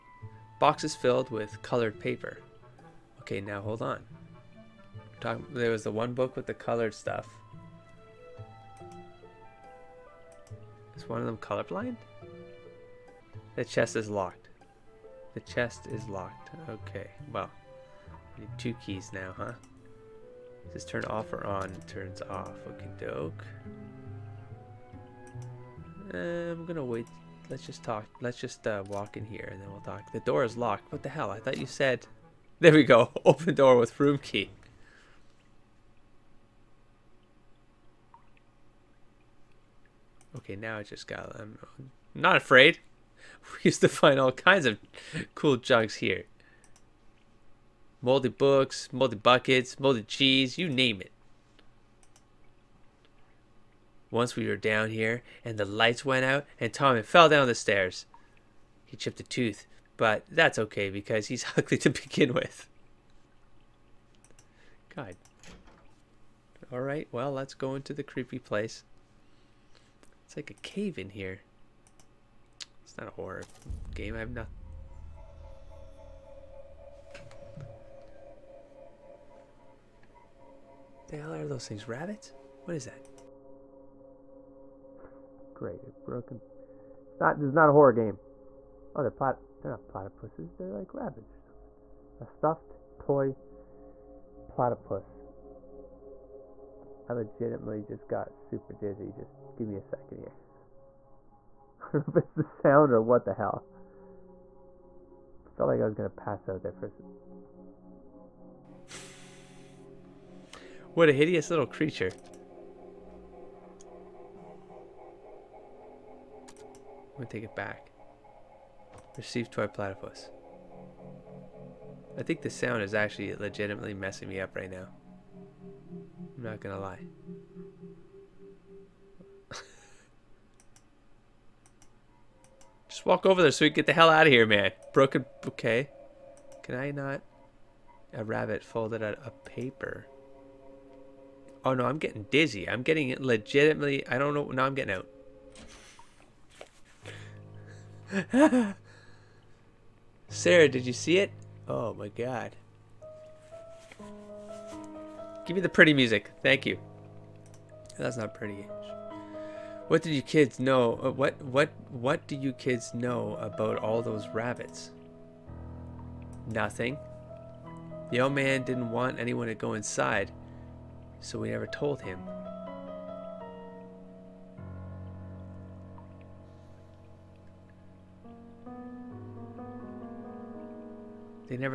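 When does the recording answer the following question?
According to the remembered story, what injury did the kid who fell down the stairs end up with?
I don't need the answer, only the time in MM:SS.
00:58.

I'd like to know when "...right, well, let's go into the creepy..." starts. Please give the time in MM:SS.
01:06.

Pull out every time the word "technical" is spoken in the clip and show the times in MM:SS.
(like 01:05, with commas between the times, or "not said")
not said.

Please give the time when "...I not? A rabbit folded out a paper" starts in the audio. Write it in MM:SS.
02:16.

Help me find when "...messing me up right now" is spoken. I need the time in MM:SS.
02:03.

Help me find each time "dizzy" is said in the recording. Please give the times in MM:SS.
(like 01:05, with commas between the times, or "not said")
01:38, 02:22.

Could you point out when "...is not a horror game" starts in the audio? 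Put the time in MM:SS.
01:27.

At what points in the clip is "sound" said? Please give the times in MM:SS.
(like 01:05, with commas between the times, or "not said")
01:42, 02:02.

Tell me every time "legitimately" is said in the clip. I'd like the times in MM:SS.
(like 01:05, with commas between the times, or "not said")
01:37, 02:03, 02:23.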